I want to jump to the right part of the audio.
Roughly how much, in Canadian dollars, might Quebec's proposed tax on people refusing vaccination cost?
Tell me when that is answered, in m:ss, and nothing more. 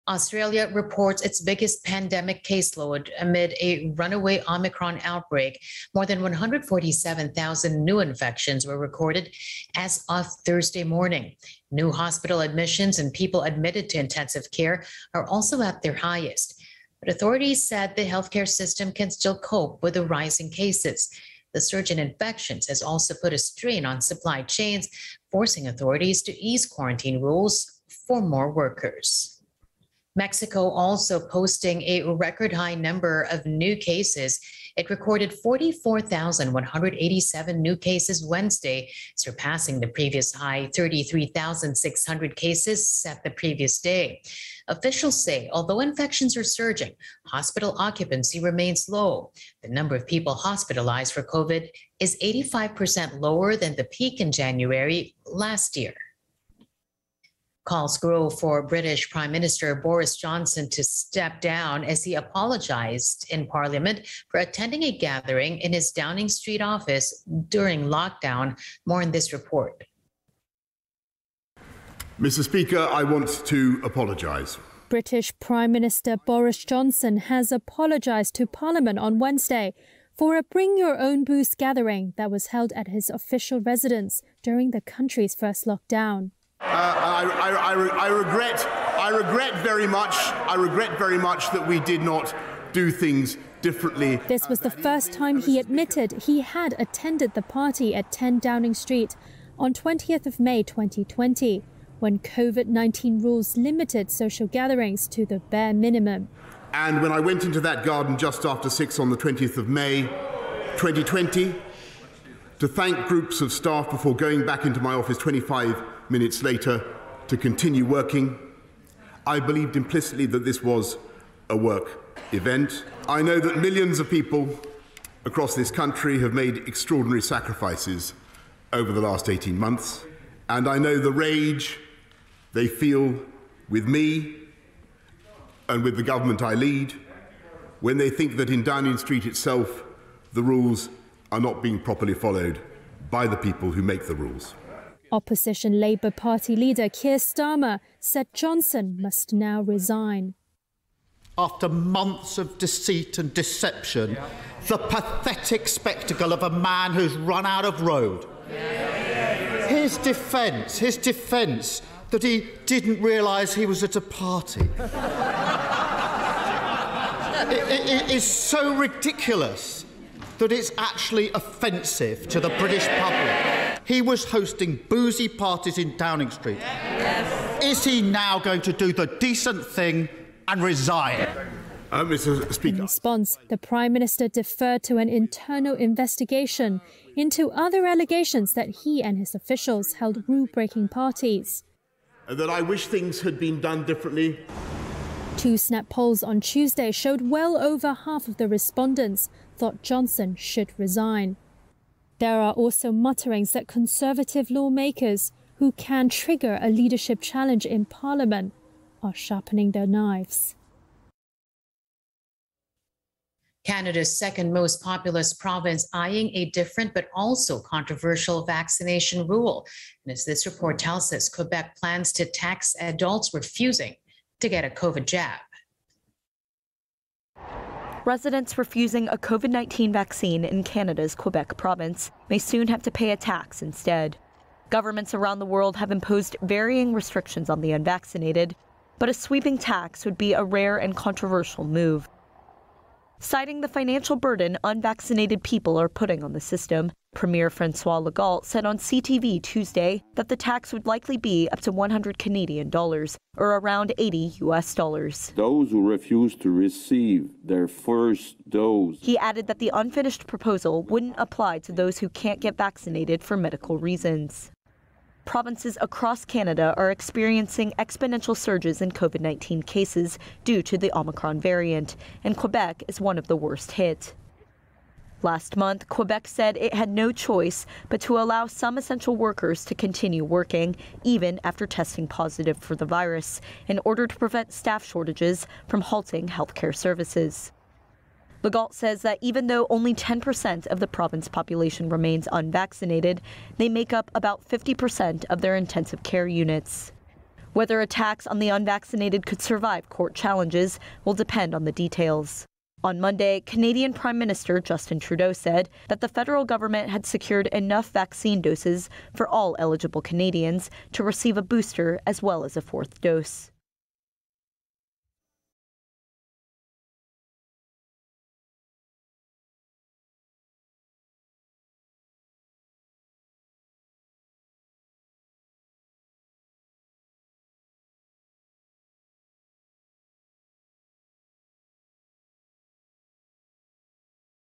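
4:11.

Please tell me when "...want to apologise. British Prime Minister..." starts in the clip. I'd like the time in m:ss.
1:13.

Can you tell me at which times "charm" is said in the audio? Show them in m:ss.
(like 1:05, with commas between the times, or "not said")
not said.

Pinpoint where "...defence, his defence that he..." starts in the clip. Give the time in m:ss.
2:39.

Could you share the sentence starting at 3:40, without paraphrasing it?
And as this report tells us, Quebec plans to tax adults refusing to get a COVID jab.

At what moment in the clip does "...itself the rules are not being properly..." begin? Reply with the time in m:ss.
2:19.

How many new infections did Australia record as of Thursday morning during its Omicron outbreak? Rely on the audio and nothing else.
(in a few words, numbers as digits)
More than 147,000.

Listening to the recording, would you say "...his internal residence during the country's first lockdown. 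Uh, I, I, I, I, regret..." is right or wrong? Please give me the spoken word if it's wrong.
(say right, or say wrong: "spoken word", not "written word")
wrong: "official", not "internal".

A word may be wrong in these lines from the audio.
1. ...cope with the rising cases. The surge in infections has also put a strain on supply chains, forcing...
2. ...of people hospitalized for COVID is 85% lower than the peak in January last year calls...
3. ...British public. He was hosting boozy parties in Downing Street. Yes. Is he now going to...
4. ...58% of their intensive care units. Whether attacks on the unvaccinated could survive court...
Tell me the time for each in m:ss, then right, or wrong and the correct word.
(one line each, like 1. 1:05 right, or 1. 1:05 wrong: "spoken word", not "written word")
1. 0:19 right
2. 0:49 right
3. 2:52 right
4. 4:54 wrong: "50", not "58".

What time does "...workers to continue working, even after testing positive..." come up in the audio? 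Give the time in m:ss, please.
4:39.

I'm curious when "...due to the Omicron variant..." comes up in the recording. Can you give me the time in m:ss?
4:30.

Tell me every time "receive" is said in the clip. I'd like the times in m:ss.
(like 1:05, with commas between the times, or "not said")
4:16, 5:11.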